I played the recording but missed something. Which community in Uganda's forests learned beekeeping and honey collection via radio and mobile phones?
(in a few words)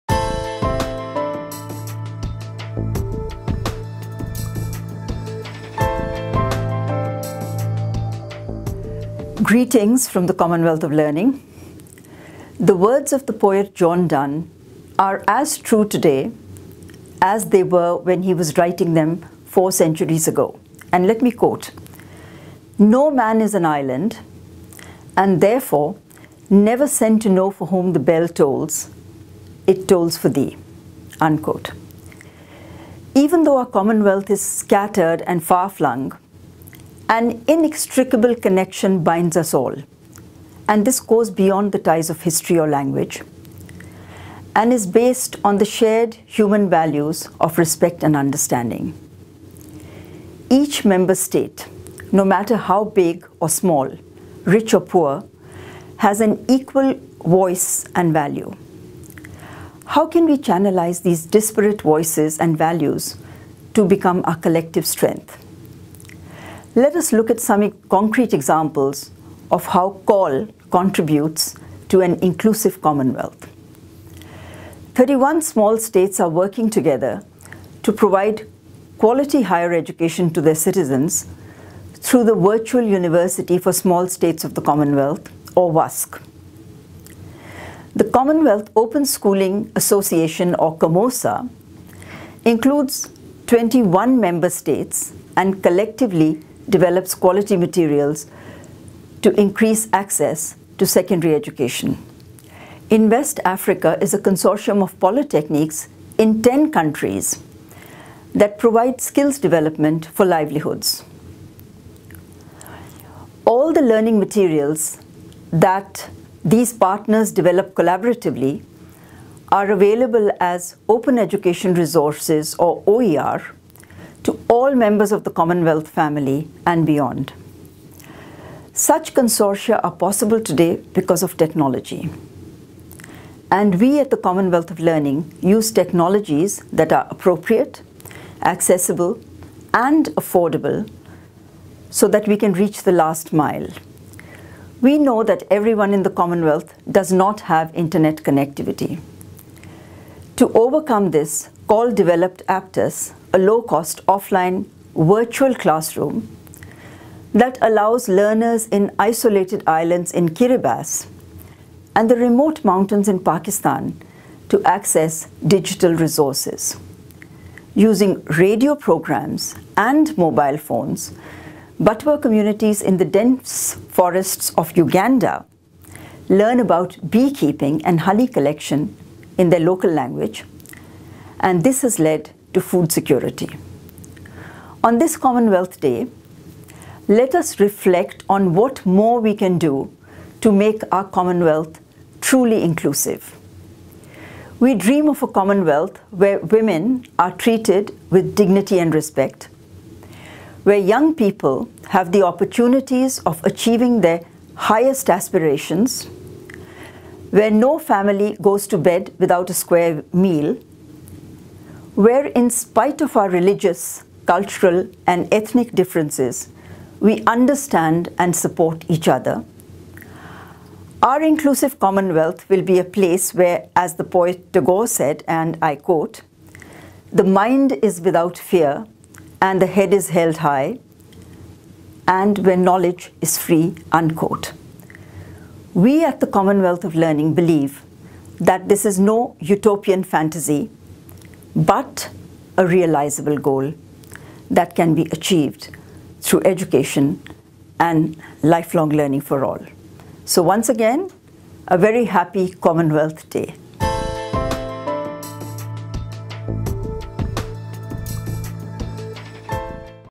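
Batwa.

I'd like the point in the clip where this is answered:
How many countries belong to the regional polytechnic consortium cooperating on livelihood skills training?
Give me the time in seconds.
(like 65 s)
106 s.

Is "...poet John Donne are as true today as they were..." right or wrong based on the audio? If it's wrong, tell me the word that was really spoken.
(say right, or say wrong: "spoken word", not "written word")
right.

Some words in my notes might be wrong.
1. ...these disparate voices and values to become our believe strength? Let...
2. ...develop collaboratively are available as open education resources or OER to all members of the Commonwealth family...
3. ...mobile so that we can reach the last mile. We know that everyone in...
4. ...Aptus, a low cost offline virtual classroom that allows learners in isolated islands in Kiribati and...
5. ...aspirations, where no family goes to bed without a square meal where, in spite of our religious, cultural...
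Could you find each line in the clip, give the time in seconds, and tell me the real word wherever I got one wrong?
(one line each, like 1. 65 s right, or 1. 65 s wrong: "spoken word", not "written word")
1. 61 s wrong: "collective", not "believe"
2. 117 s right
3. 140 s wrong: "affordable", not "mobile"
4. 152 s right
5. 205 s right.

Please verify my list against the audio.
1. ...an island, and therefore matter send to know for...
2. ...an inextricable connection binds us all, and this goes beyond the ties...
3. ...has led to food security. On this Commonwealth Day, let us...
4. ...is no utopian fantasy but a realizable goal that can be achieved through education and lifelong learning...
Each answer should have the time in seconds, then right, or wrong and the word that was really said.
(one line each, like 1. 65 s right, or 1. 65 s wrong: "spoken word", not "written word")
1. 23 s wrong: "never", not "matter"
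2. 37 s right
3. 181 s right
4. 238 s right.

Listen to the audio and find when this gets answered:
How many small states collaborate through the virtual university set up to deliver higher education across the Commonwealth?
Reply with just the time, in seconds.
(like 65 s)
74 s.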